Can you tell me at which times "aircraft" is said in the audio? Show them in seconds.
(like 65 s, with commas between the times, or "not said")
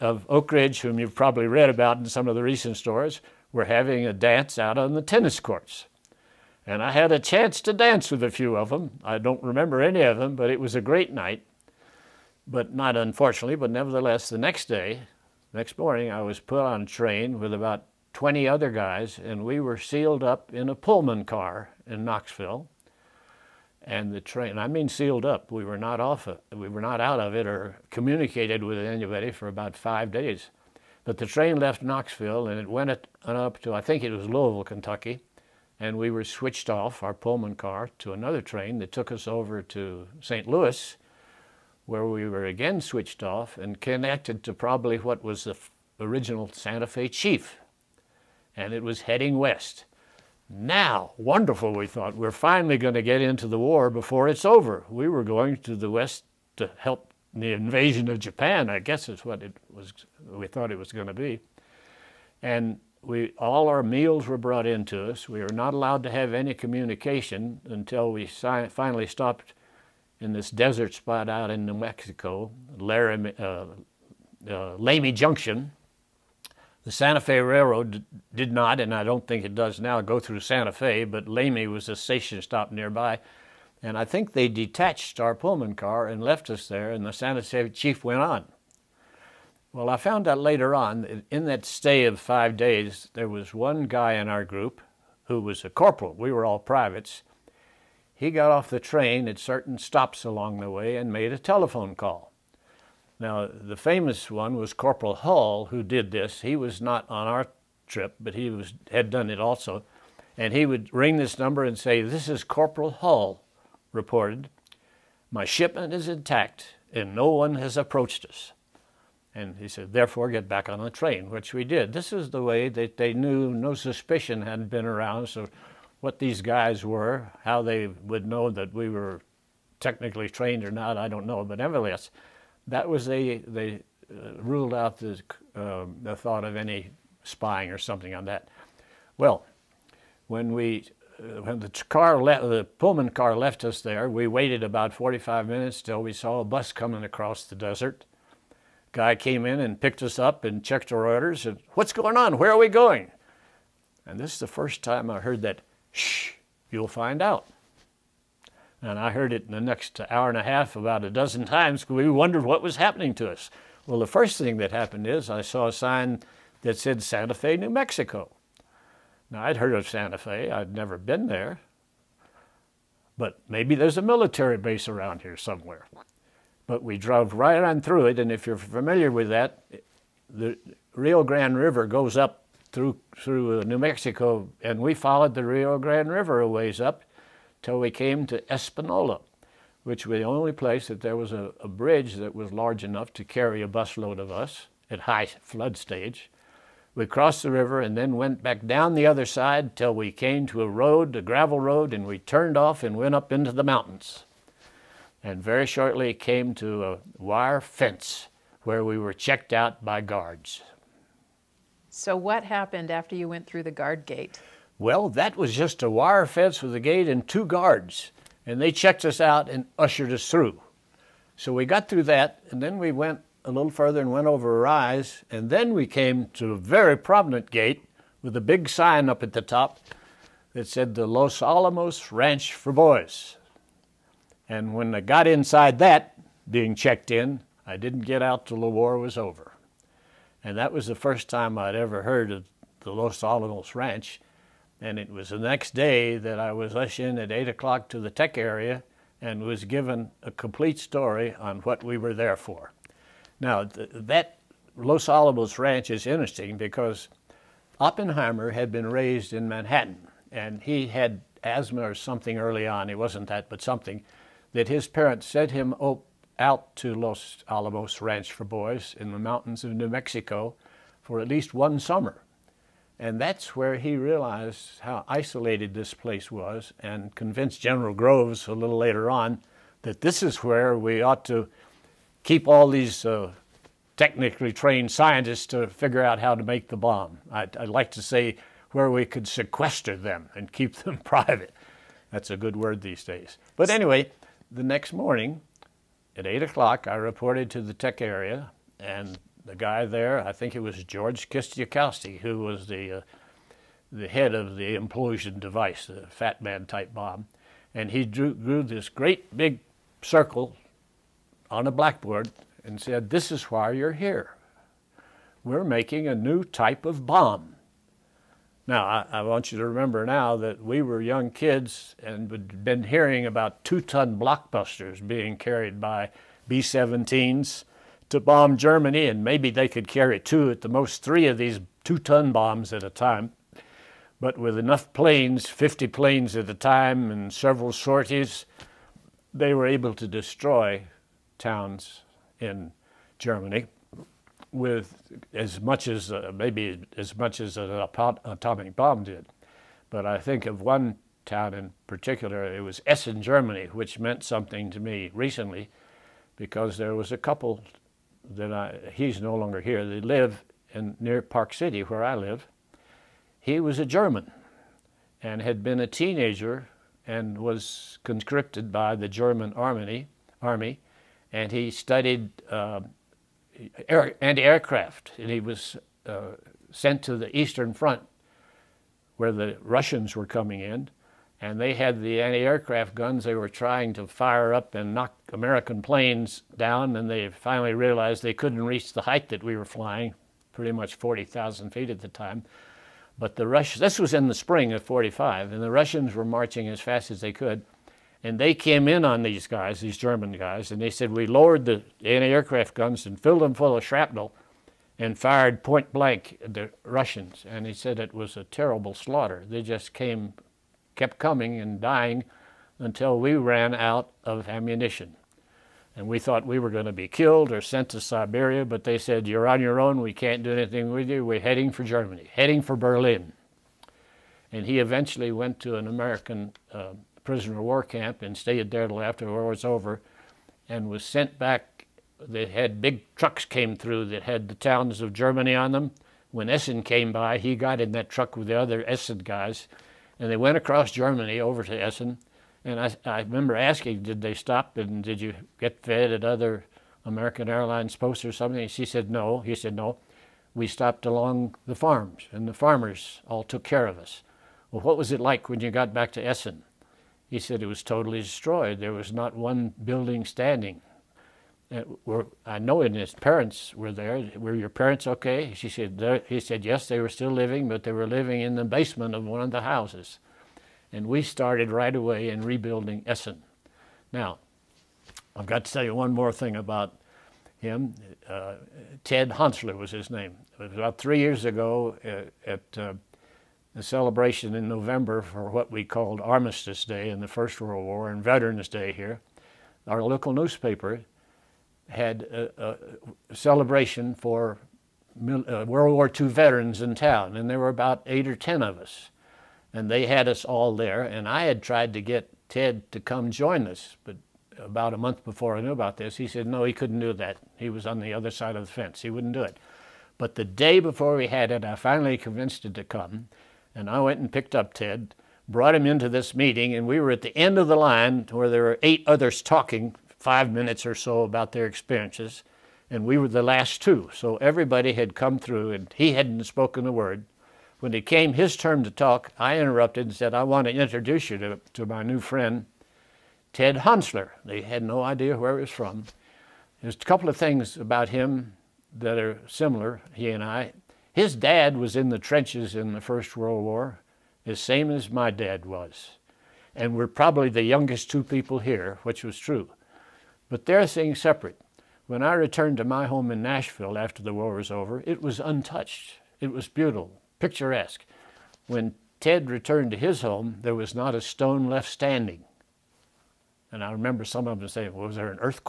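374 s, 382 s, 402 s.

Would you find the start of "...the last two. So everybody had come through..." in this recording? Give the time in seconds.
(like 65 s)
523 s.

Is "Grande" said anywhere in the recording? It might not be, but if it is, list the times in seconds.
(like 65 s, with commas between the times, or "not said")
181 s, 185 s.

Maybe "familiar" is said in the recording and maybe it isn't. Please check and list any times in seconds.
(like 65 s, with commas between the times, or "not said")
178 s.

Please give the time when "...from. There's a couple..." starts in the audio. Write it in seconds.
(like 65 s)
535 s.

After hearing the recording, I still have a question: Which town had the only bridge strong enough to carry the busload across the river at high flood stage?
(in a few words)
Espanola.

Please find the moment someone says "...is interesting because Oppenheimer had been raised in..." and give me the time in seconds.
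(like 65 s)
255 s.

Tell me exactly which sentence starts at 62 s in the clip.
And we, all our meals were brought into us.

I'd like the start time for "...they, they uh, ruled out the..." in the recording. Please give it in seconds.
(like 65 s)
133 s.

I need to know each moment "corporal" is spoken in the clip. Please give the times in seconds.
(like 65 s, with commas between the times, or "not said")
95 s, 104 s, 112 s.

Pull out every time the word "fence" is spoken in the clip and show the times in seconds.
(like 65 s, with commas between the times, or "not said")
207 s, 216 s, 508 s.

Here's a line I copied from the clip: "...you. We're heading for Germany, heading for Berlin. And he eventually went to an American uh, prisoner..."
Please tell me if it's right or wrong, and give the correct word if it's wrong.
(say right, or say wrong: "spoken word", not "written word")
right.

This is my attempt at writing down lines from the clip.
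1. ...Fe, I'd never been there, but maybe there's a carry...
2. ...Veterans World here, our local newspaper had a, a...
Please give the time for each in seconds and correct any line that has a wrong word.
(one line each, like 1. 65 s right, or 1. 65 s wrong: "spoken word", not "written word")
1. 170 s wrong: "military", not "carry"
2. 488 s wrong: "Day", not "World".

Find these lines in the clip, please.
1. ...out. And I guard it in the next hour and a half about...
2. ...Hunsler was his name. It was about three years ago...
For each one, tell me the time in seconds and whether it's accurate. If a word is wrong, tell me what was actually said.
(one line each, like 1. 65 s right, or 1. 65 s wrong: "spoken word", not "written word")
1. 157 s wrong: "heard", not "guard"
2. 479 s right.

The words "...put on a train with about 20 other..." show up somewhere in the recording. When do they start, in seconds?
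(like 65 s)
16 s.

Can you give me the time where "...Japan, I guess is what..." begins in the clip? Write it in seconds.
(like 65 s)
58 s.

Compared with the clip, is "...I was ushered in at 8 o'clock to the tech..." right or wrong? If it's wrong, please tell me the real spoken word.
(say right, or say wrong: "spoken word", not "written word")
right.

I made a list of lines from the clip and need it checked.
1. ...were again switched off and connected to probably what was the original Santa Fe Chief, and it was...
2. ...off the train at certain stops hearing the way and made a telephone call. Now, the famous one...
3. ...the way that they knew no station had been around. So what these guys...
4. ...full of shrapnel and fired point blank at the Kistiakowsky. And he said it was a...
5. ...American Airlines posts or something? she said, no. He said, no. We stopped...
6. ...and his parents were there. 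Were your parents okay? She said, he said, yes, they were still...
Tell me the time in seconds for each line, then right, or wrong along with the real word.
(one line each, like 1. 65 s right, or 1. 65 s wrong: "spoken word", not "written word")
1. 42 s right
2. 98 s wrong: "along", not "hearing"
3. 122 s wrong: "suspicion", not "station"
4. 403 s wrong: "Russians", not "Kistiakowsky"
5. 447 s right
6. 462 s right.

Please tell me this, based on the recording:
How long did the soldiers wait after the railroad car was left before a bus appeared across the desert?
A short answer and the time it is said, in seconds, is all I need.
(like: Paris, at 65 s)
45 minutes, at 144 s.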